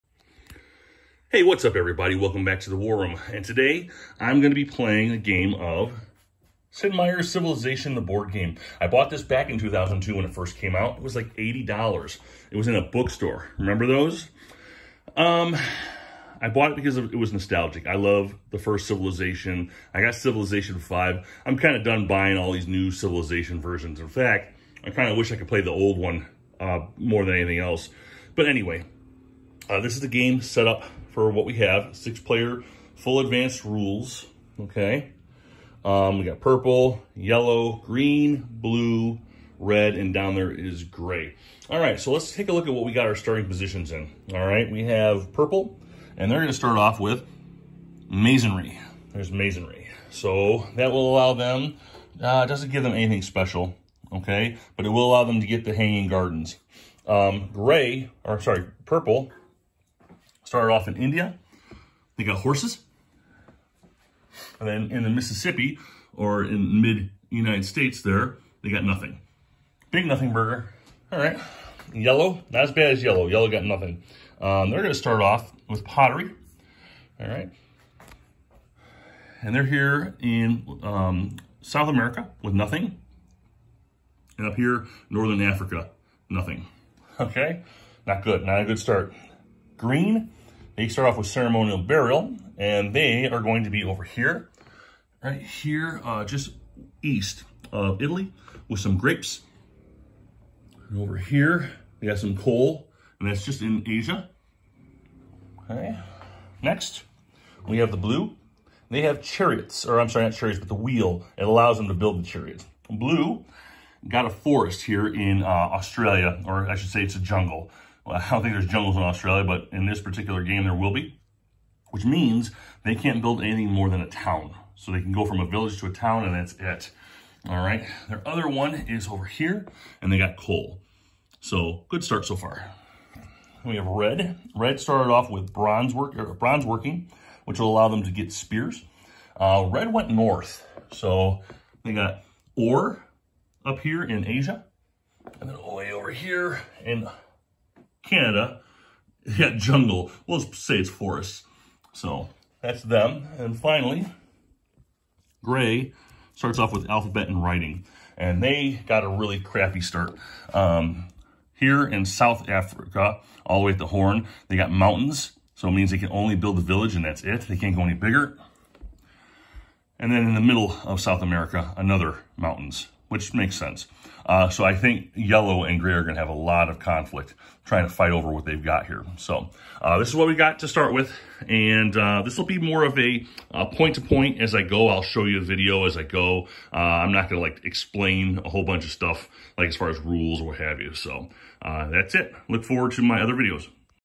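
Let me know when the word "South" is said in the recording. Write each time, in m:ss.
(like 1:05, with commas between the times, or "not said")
1:21, 2:42, 2:50.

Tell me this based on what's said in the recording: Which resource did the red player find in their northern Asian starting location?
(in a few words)
Ore.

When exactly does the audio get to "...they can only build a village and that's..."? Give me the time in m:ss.
2:45.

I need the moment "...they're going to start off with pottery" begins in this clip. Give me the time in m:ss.
1:14.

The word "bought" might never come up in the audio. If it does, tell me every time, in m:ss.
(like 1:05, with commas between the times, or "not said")
0:08, 0:16.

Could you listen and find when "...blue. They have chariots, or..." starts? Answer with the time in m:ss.
1:47.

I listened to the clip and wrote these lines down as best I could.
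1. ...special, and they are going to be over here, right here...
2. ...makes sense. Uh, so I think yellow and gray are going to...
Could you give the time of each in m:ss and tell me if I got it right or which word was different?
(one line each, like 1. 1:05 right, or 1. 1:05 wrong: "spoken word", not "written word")
1. 1:31 wrong: "burial", not "special"
2. 2:53 right.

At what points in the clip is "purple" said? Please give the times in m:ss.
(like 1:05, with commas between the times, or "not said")
0:36, 0:45, 0:58.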